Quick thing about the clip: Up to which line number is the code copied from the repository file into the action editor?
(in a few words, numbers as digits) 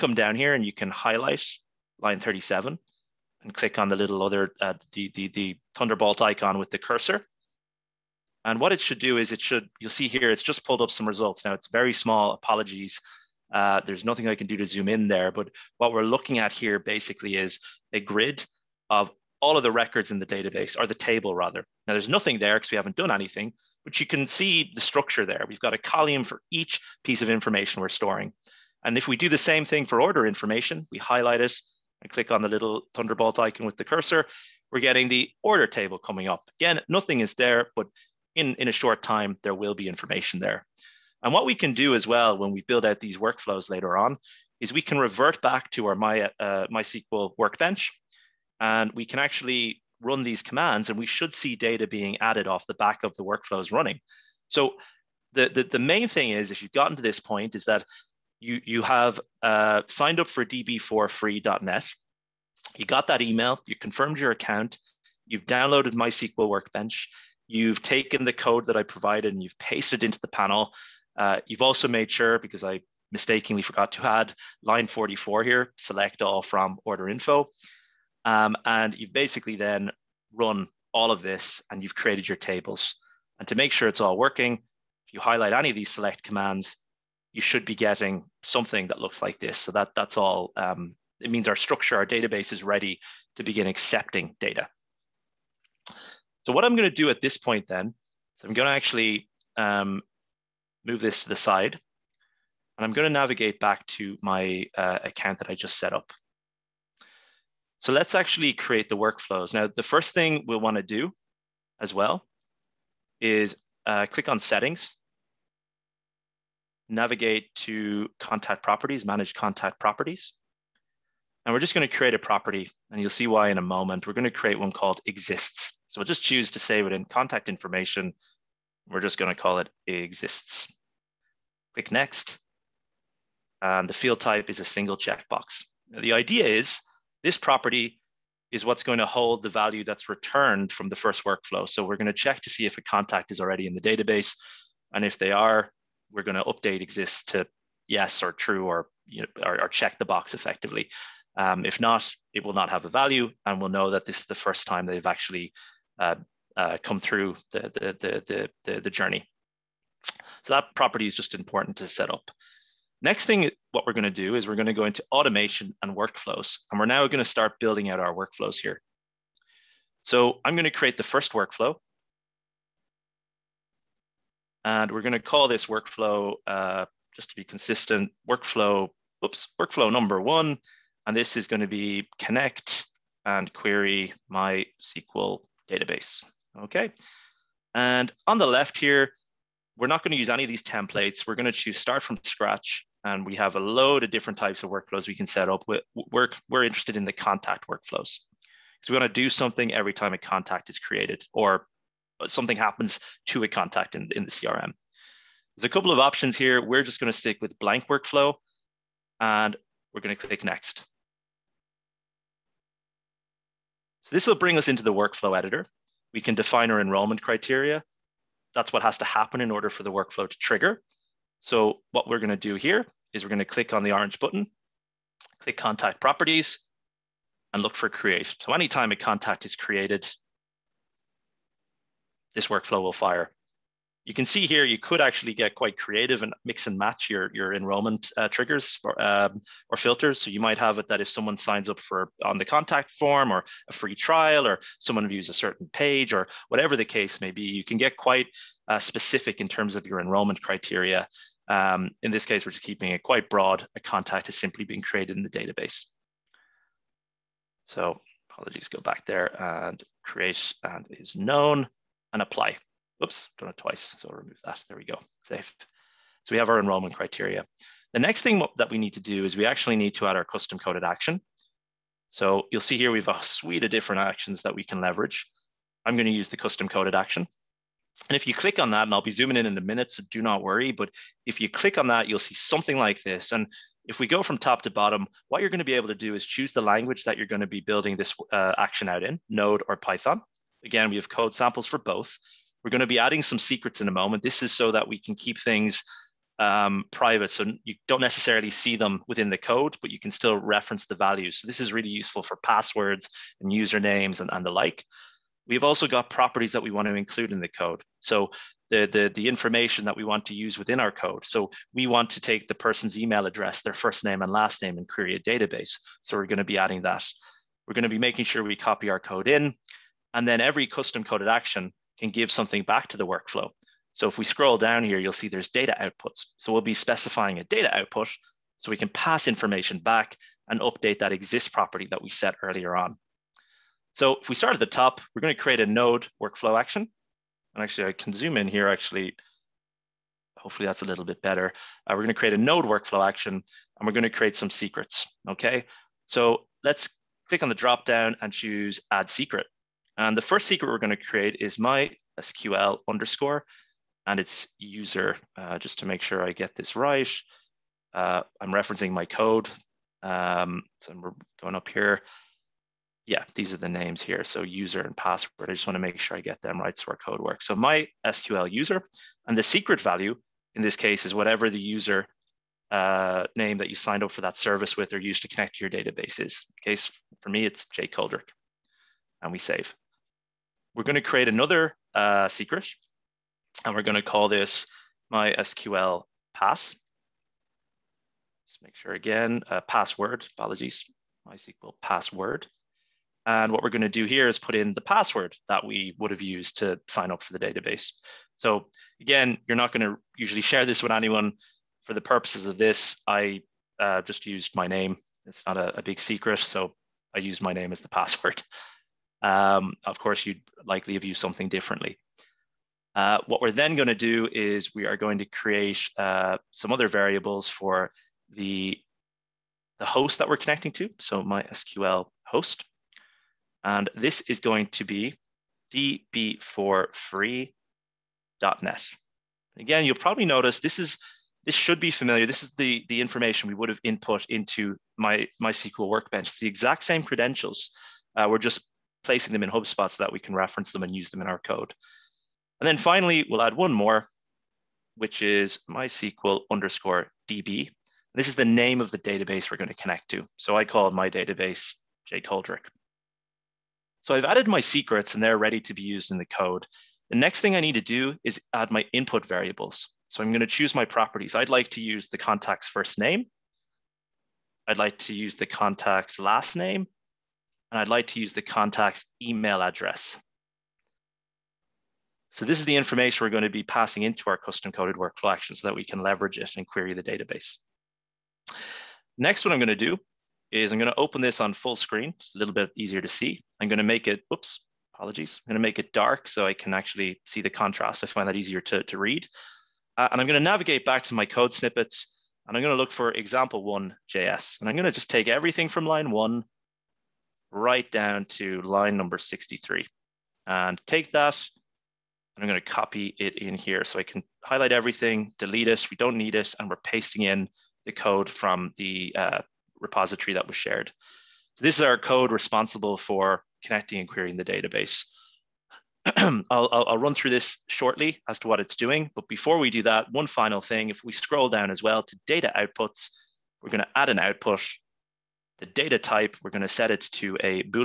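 63.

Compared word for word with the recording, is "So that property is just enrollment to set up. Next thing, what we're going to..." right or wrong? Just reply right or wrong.
wrong.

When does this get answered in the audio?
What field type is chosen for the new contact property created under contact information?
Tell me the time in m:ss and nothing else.
2:14.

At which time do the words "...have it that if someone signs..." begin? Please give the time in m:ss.
4:00.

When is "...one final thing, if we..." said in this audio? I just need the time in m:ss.
8:40.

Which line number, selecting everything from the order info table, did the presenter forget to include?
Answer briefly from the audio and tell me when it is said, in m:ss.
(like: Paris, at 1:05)
44, at 1:14.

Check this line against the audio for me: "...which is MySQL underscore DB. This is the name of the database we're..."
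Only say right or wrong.
right.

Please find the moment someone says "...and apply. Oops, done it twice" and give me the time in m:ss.
4:22.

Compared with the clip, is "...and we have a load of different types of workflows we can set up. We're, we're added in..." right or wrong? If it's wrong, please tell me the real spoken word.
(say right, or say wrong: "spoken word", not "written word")
wrong: "interested", not "added".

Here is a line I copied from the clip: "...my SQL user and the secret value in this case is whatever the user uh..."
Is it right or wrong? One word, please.
right.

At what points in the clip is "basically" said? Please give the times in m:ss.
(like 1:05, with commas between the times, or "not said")
0:16, 1:19.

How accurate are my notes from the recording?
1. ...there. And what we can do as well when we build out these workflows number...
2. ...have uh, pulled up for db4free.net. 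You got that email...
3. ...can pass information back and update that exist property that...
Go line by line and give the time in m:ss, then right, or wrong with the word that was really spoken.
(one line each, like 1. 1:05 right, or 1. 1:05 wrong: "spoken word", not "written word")
1. 0:40 wrong: "later", not "number"
2. 0:58 wrong: "signed", not "pulled"
3. 5:28 right.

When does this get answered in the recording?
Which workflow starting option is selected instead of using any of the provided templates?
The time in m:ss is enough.
3:27.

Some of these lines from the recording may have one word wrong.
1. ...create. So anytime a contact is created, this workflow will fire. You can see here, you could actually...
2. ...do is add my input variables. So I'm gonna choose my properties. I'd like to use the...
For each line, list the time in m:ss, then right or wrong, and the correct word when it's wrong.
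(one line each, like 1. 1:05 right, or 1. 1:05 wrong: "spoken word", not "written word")
1. 3:47 right
2. 7:37 right.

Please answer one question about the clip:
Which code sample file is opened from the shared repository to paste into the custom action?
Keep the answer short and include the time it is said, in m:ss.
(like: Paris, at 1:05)
example one JS, at 8:13.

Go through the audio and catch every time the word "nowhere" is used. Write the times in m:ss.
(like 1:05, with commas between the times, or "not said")
not said.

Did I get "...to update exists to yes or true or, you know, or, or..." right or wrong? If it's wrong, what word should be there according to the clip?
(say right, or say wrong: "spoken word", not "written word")
right.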